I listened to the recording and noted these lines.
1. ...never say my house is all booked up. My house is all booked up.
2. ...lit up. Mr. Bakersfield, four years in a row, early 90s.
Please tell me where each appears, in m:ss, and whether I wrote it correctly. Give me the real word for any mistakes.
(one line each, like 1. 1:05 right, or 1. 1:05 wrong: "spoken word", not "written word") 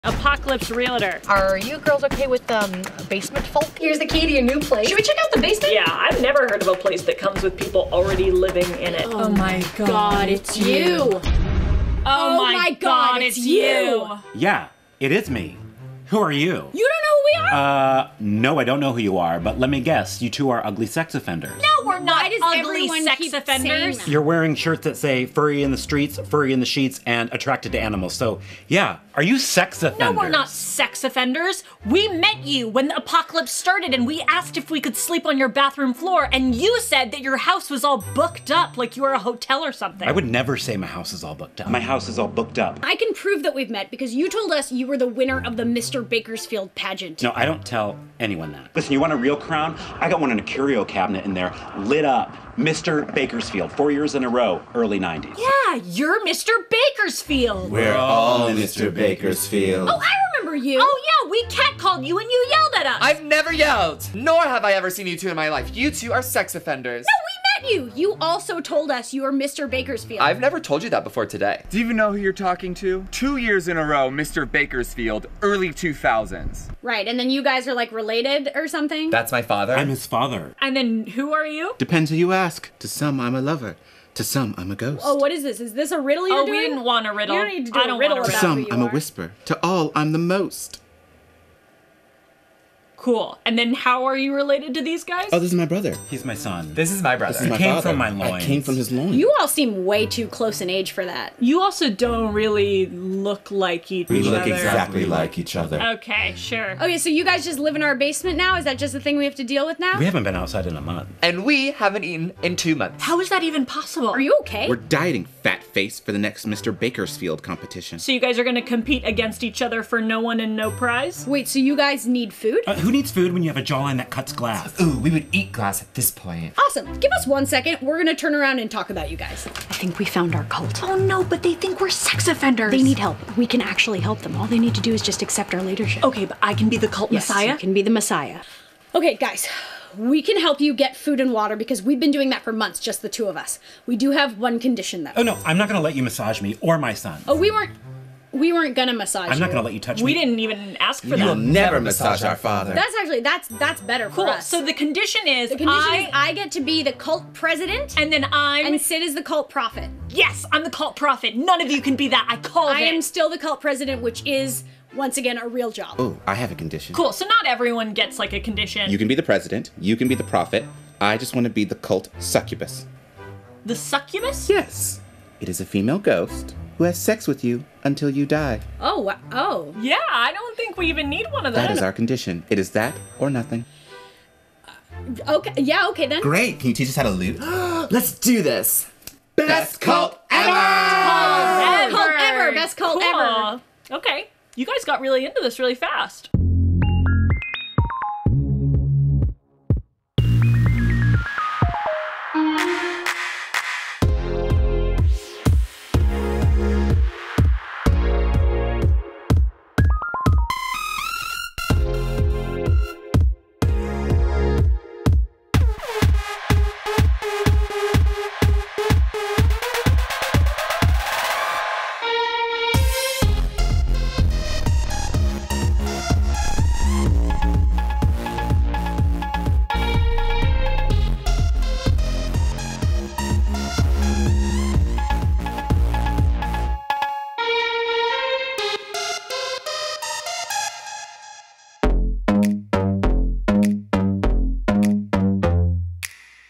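1. 0:40 right
2. 0:51 right.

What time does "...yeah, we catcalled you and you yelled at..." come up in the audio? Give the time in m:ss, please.
1:01.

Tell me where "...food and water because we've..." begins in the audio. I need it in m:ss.
2:20.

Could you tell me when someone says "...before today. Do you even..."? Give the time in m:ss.
1:11.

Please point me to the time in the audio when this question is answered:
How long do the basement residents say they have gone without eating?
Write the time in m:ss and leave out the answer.
1:52.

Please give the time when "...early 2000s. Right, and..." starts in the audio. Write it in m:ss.
1:15.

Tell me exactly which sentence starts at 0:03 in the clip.
Here's the key to your new place.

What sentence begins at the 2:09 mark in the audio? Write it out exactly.
I think we found our cult.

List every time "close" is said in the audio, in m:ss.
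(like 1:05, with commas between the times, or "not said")
1:40.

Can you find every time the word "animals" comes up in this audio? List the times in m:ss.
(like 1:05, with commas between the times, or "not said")
0:27.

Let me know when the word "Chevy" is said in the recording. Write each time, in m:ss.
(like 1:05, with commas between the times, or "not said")
not said.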